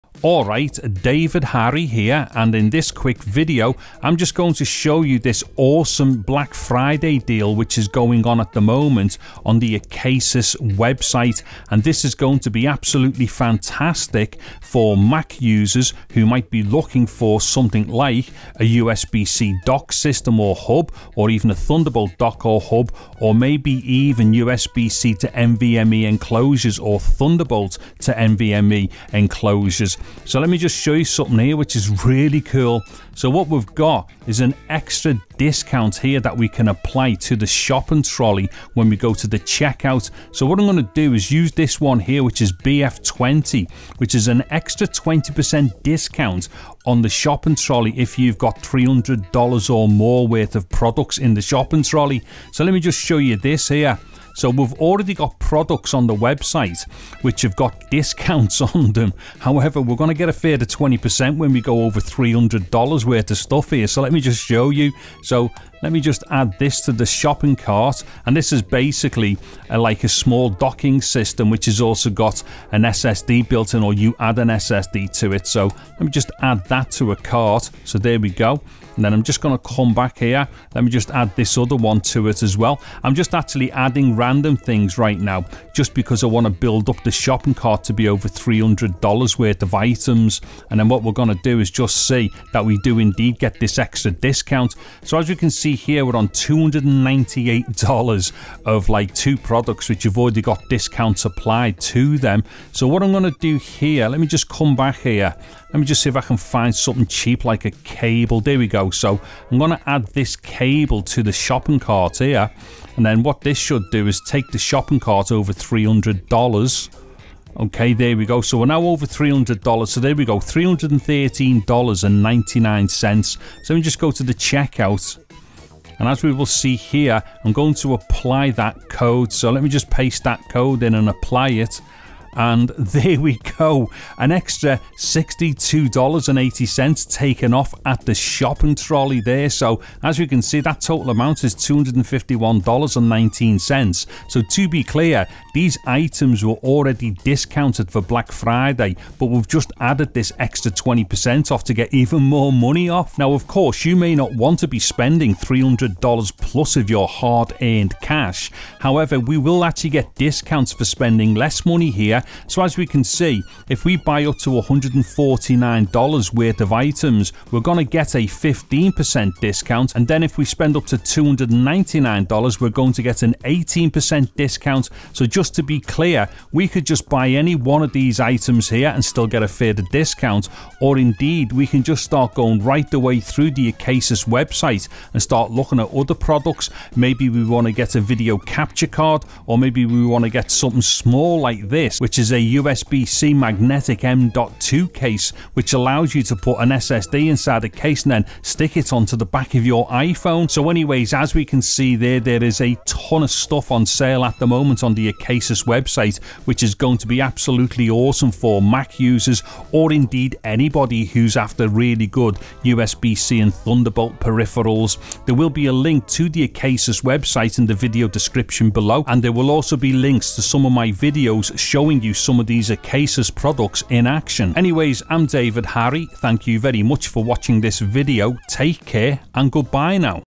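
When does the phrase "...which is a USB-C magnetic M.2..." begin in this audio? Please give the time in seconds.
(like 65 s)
192 s.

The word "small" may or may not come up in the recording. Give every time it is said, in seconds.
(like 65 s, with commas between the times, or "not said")
70 s, 190 s.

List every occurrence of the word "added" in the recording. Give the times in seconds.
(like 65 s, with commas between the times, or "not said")
149 s.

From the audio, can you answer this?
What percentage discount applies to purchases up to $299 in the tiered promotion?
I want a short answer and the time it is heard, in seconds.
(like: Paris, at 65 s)
18%, at 173 s.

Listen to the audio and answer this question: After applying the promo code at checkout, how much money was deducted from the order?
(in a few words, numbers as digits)
$62.80.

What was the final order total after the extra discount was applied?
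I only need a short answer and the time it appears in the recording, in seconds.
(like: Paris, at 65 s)
$251.19, at 141 s.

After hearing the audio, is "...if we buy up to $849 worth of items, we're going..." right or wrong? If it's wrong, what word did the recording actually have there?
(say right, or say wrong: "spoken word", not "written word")
wrong: "149", not "849".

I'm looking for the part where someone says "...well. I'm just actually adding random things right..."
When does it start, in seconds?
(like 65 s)
82 s.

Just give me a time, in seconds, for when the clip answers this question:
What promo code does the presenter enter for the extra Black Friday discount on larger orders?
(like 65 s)
42 s.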